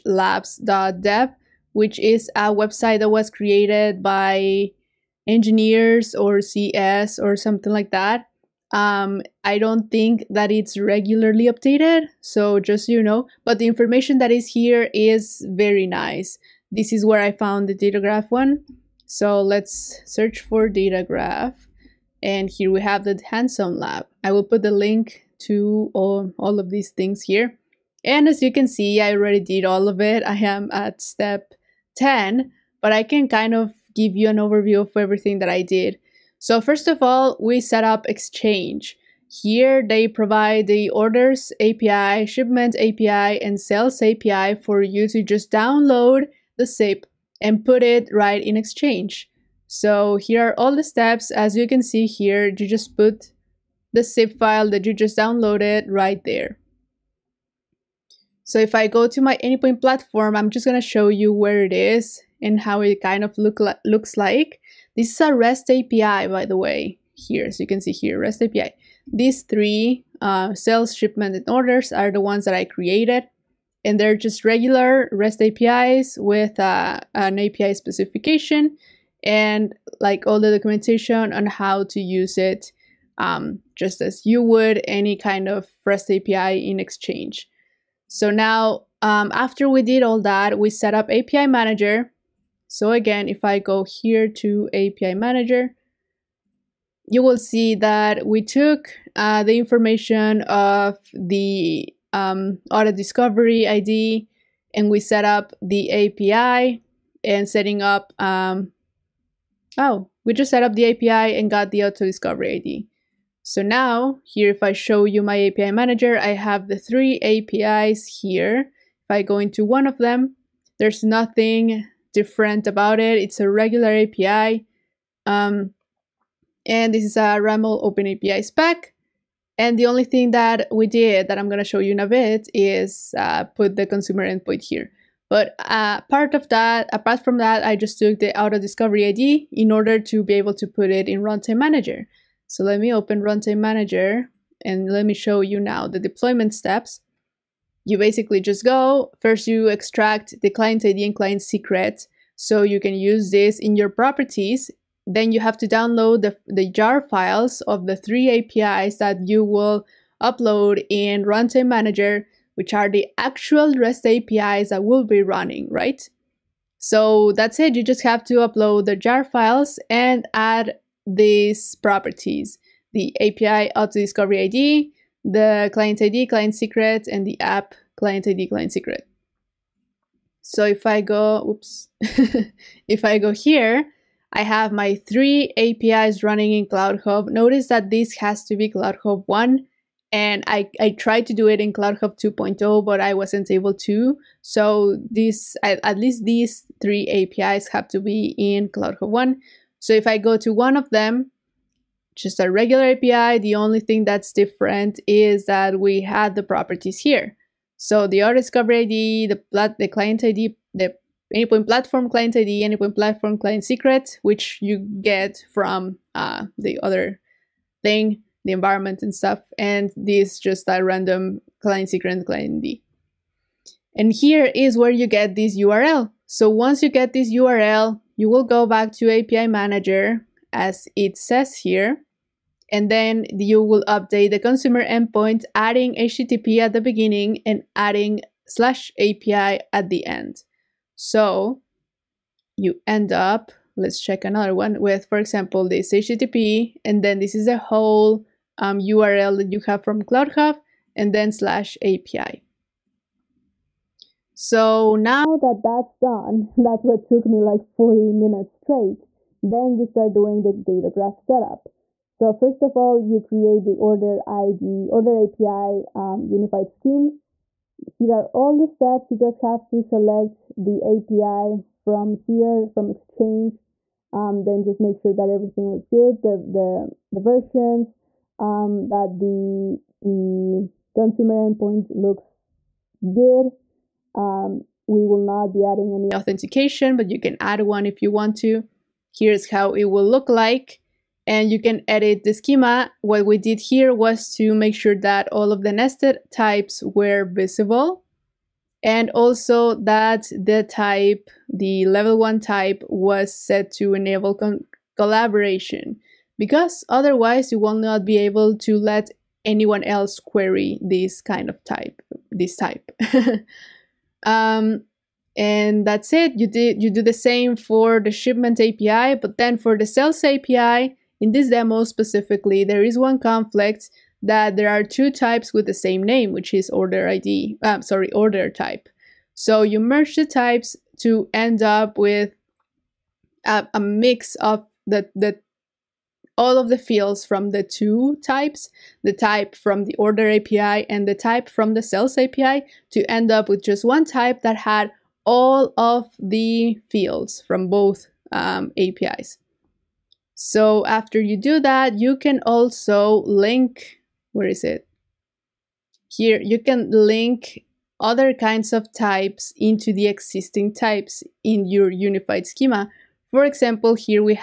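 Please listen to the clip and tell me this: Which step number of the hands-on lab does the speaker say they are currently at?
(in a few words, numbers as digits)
10.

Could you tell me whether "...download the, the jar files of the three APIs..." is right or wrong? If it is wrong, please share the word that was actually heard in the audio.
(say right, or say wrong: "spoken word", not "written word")
right.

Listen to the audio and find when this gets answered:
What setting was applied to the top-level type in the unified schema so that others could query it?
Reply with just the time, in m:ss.
5:03.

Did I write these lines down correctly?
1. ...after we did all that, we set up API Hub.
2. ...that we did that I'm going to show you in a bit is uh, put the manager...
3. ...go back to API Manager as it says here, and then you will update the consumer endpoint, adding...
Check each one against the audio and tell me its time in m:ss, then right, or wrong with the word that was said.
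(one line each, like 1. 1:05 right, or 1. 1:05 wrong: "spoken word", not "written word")
1. 1:29 wrong: "Manager", not "Hub"
2. 2:10 wrong: "consumer", not "manager"
3. 3:48 right.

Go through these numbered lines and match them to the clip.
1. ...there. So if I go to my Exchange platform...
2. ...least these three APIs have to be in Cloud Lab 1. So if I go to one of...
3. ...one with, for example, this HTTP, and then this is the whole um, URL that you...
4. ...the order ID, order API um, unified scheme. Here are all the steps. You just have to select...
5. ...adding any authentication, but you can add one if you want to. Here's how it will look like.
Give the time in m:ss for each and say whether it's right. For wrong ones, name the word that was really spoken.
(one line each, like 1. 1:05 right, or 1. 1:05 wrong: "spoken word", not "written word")
1. 0:56 wrong: "Anypoint", not "Exchange"
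2. 3:15 wrong: "Hub", not "Lab"
3. 4:04 right
4. 4:23 right
5. 4:45 right.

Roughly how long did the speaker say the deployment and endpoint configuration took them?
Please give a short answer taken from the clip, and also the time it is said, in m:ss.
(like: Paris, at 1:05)
40 minutes, at 4:17.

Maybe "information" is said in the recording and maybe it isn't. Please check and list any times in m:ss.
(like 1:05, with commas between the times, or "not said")
0:13, 1:39.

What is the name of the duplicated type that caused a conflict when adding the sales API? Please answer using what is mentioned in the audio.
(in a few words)
order type.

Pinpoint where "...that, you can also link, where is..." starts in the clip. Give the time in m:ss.
5:51.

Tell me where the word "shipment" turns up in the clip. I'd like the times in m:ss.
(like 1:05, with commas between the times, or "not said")
0:42, 1:10, 5:18.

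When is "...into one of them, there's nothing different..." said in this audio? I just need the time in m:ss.
1:59.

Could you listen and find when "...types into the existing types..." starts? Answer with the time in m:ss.
5:58.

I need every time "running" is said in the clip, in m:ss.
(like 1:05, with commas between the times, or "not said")
2:45, 3:06.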